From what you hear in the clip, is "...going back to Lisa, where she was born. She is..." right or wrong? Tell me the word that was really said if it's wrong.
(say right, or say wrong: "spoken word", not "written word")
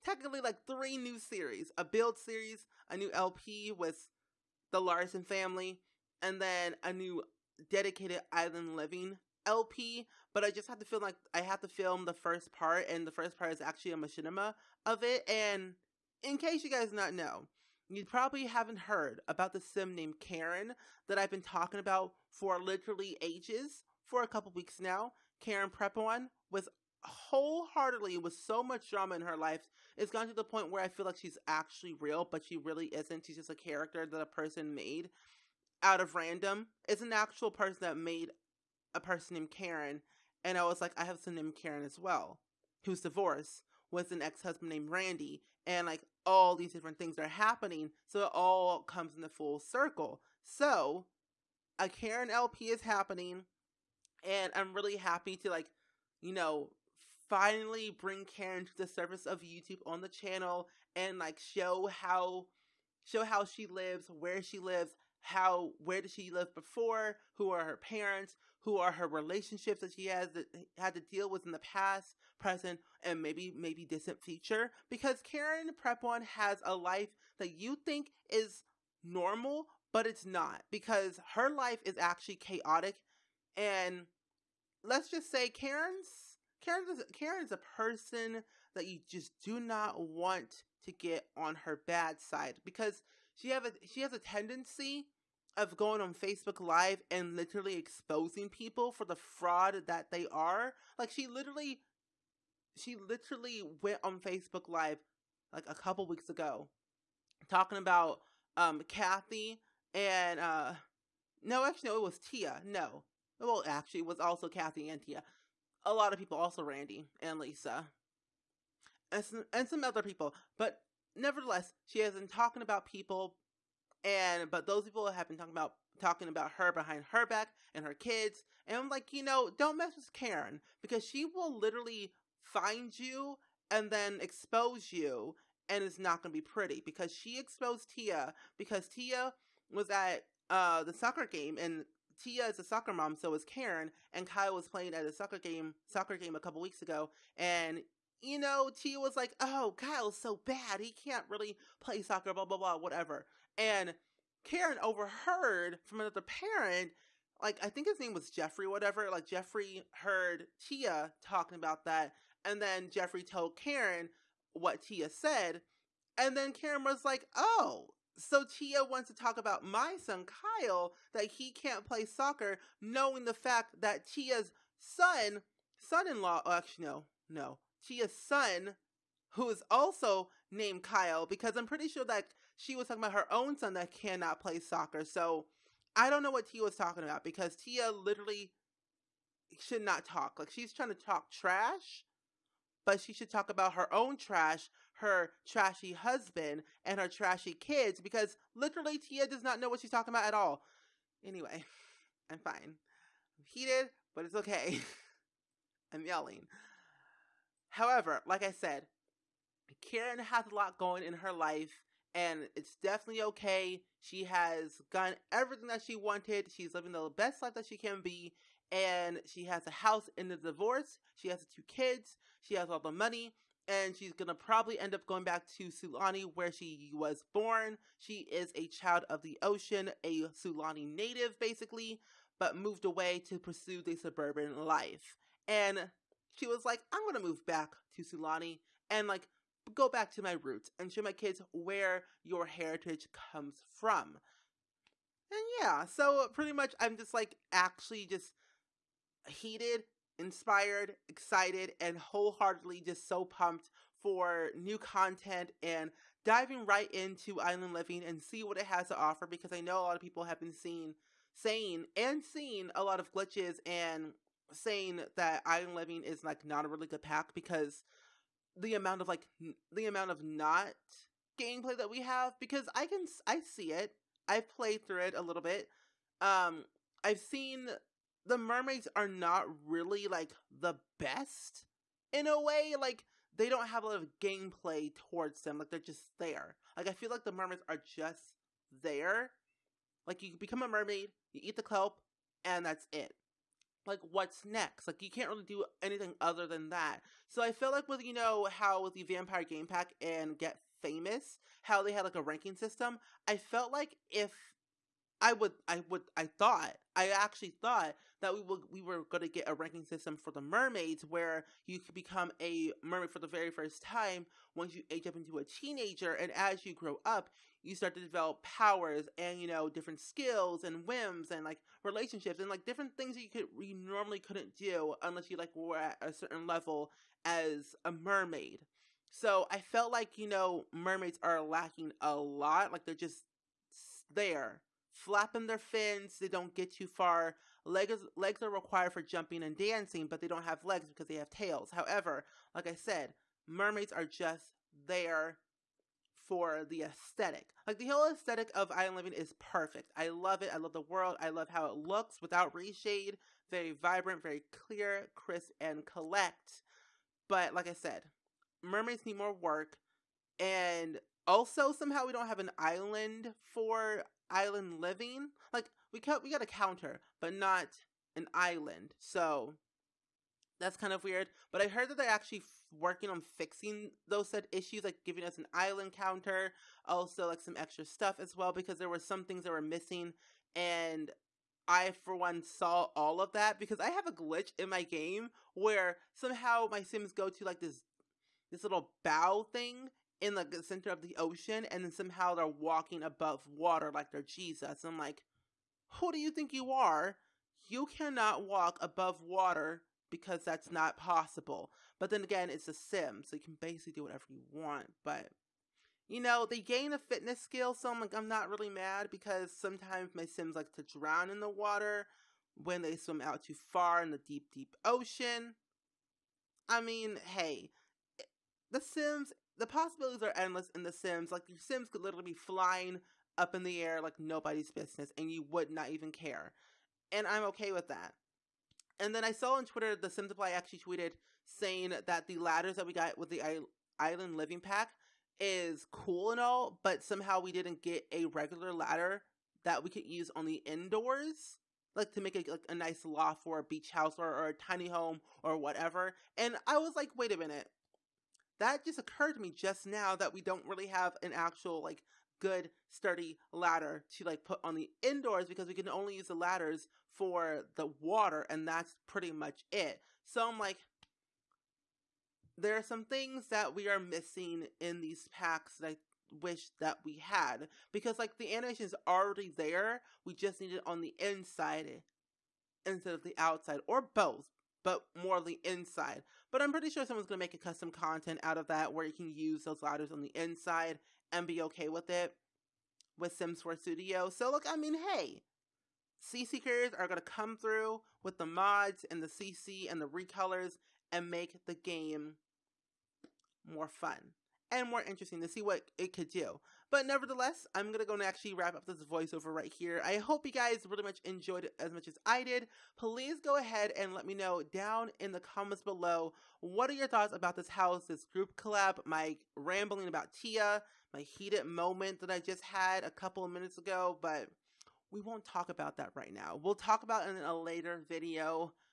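wrong: "Sulani", not "Lisa".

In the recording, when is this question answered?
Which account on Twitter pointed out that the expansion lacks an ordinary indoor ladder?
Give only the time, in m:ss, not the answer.
7:09.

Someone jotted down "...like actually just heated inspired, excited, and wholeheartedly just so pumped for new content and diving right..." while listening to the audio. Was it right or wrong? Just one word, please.
right.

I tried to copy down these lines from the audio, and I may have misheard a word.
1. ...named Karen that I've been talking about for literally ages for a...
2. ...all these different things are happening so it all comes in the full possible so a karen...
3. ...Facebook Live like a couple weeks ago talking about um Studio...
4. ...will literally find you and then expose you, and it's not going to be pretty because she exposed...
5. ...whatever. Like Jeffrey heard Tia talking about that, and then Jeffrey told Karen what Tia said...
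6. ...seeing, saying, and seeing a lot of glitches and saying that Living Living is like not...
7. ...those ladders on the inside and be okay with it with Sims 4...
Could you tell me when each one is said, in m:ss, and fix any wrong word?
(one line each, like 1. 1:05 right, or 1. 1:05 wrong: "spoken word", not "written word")
1. 0:19 right
2. 0:46 wrong: "circle", not "possible"
3. 1:44 wrong: "Kathy", not "Studio"
4. 2:11 right
5. 2:38 right
6. 4:20 wrong: "Island", not "Living"
7. 7:59 right.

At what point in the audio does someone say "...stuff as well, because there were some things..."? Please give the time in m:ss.
6:17.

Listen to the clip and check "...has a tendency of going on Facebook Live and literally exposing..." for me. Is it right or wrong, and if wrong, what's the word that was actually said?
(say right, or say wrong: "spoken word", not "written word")
right.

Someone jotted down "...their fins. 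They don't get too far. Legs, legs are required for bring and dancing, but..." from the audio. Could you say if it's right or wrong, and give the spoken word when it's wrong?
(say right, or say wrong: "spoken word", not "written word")
wrong: "jumping", not "bring".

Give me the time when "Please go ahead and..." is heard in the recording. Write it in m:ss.
8:22.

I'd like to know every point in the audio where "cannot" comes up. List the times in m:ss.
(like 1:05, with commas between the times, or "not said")
3:03, 6:37.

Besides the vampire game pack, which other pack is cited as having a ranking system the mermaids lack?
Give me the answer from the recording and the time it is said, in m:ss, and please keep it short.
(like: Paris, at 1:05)
Get Famous, at 5:00.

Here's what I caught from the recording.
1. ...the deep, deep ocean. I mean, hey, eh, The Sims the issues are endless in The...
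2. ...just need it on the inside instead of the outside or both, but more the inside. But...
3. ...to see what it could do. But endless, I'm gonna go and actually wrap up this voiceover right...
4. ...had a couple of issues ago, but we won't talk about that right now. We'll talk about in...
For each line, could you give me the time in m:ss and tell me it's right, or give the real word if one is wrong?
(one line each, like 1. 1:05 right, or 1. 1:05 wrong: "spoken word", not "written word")
1. 6:54 wrong: "possibilities", not "issues"
2. 7:50 right
3. 8:15 wrong: "nevertheless", not "endless"
4. 8:32 wrong: "minutes", not "issues".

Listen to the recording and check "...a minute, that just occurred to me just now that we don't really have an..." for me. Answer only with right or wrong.
right.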